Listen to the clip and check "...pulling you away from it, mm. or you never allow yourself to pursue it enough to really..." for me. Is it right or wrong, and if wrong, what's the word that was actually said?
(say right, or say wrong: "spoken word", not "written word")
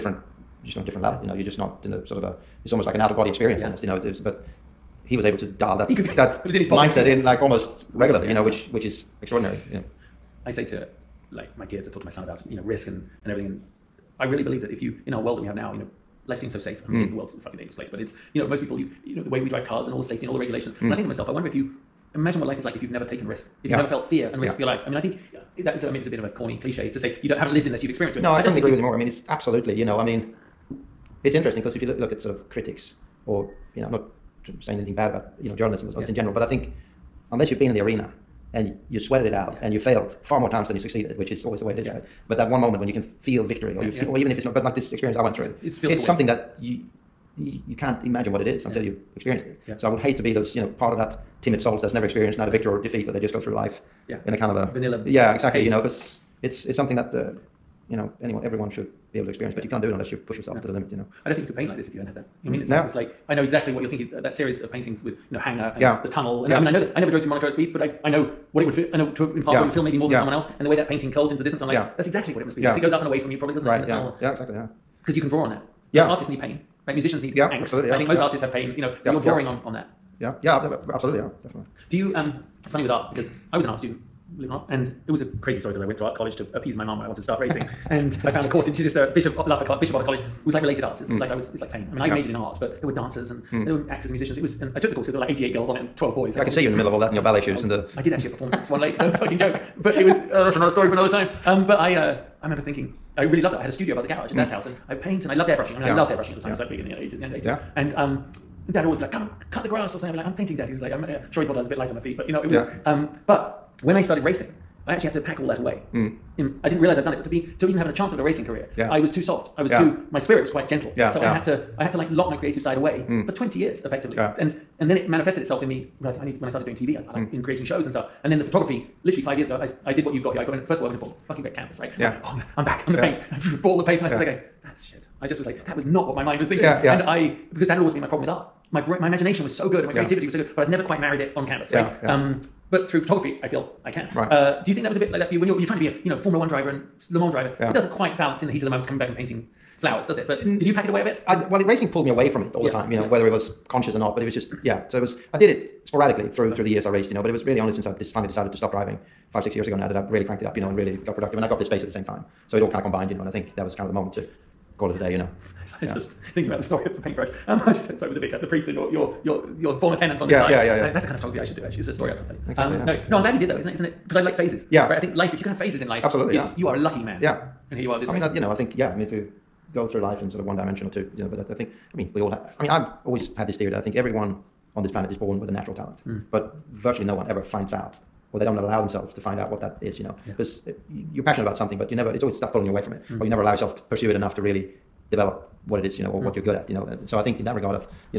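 right.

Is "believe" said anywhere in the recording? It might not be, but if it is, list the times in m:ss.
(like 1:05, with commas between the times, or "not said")
0:14, 1:24.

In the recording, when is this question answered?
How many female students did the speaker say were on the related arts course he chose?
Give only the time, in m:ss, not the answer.
1:35.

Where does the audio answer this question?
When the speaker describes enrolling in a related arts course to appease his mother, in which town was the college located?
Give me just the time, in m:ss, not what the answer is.
1:28.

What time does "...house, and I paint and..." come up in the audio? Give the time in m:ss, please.
1:44.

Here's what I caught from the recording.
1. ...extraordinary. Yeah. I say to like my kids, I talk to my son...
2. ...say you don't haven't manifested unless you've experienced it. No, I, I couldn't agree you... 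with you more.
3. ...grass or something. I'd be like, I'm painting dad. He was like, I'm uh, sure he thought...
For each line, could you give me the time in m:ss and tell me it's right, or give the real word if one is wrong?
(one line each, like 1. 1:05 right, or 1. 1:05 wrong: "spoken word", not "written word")
1. 0:09 right
2. 0:26 wrong: "lived", not "manifested"
3. 1:49 right.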